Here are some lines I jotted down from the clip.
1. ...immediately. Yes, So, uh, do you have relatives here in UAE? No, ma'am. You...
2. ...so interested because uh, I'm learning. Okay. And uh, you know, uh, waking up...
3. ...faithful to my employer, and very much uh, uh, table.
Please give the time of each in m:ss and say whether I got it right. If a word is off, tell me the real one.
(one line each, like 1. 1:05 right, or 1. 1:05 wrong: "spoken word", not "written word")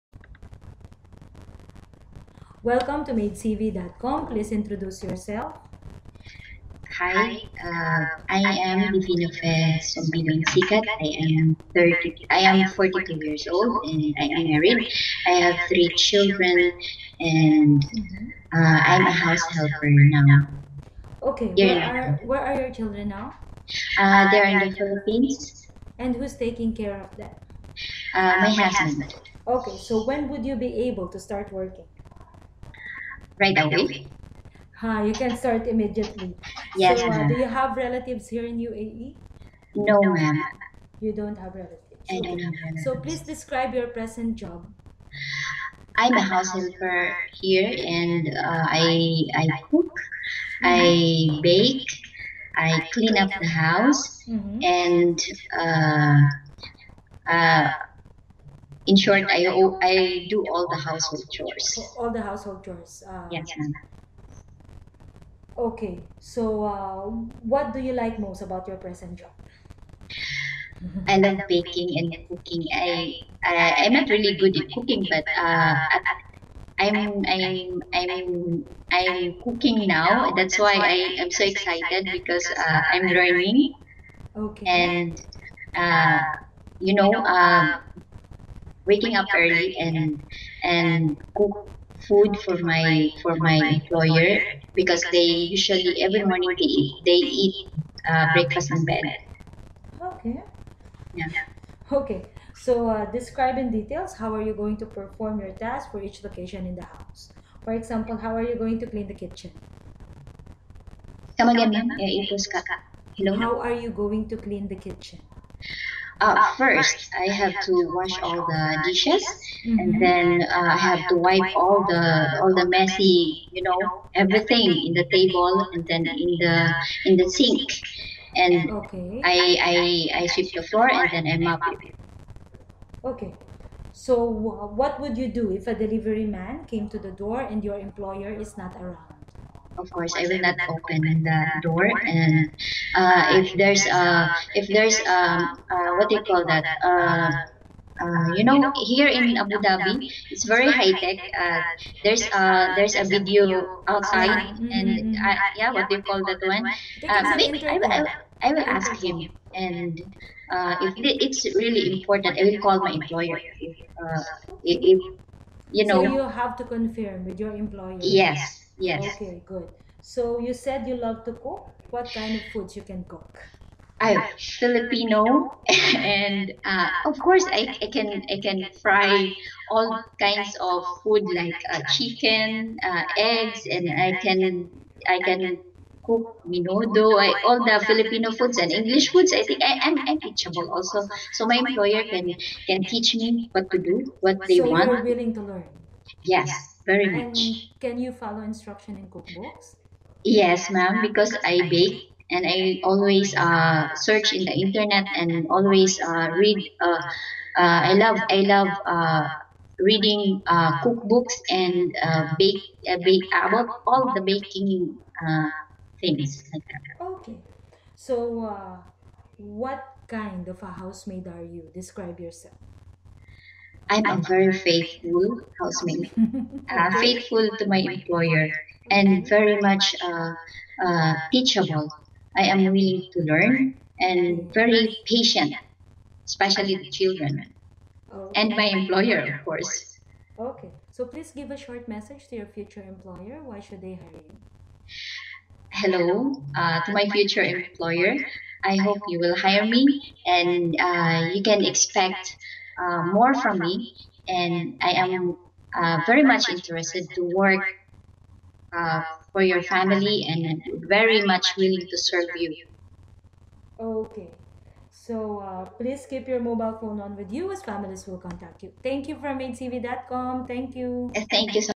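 1. 0:35 right
2. 1:21 wrong: "excited", not "interested"
3. 3:47 wrong: "teachable", not "table".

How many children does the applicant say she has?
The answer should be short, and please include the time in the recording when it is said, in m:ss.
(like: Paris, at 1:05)
3, at 0:15.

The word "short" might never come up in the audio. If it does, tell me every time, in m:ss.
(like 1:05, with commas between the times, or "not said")
0:59, 4:01.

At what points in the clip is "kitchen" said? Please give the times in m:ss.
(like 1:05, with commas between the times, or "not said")
1:49, 1:54.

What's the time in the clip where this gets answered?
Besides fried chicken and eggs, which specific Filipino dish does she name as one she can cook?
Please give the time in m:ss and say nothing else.
3:06.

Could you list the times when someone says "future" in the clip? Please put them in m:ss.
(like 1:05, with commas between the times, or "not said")
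4:02, 4:07.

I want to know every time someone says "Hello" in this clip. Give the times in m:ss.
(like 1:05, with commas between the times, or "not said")
1:53, 4:05.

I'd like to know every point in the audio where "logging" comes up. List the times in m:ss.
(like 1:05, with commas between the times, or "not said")
not said.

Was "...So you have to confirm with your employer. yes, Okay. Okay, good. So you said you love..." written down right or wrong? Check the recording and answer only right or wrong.
wrong.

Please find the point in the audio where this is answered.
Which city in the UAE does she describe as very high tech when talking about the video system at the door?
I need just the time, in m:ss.
2:29.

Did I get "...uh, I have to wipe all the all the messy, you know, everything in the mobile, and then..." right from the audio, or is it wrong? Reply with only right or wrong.
wrong.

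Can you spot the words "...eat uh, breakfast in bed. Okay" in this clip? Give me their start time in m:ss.
1:37.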